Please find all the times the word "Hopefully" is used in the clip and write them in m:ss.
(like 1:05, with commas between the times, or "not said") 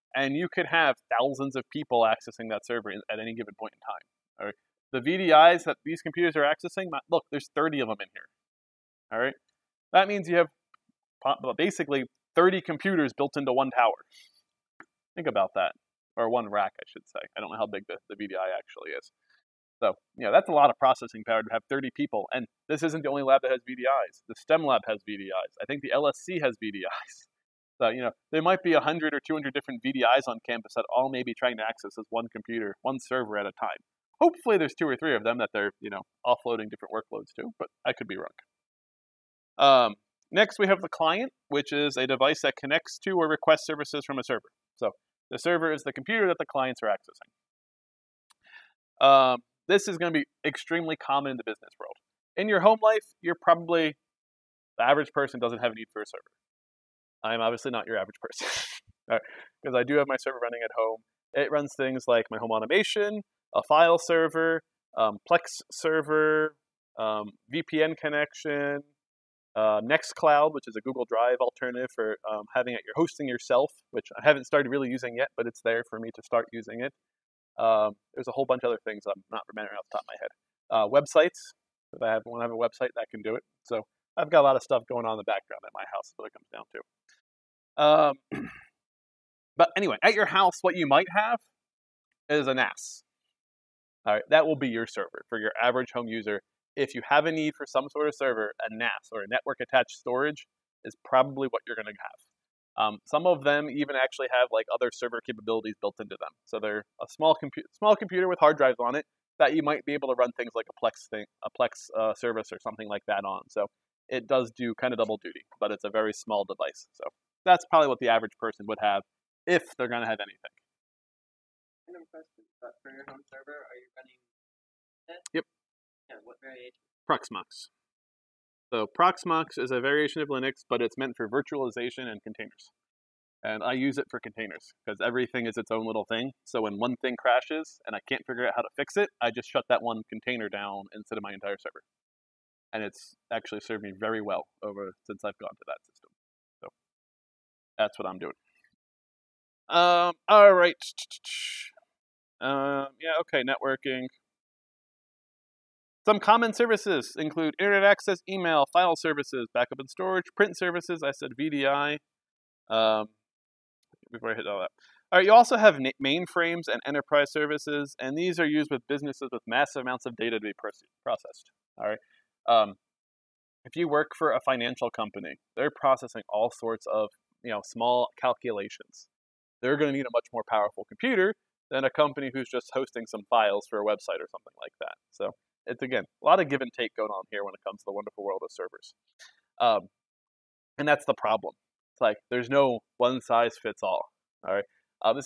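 0:34.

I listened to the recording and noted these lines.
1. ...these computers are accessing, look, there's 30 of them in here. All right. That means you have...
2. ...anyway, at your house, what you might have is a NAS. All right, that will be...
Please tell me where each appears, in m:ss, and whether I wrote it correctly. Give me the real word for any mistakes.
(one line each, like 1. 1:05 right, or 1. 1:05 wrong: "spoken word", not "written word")
1. 0:05 right
2. 1:29 right.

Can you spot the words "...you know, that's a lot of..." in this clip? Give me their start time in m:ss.
0:20.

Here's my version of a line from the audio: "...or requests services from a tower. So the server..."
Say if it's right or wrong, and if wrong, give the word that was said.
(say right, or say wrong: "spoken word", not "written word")
wrong: "server", not "tower".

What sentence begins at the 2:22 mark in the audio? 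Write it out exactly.
And it's actually served me very well over since I've gone to that system.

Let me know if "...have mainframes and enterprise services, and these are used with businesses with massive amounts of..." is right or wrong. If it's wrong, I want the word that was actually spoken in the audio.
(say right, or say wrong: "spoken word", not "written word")
right.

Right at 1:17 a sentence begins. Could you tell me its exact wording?
Um, there's a whole bunch of other things I'm not remembering off the top of my head.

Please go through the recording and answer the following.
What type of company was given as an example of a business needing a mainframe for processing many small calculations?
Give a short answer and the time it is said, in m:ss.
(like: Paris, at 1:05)
financial company, at 2:54.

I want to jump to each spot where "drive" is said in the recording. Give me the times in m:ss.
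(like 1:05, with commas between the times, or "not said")
1:11, 1:48.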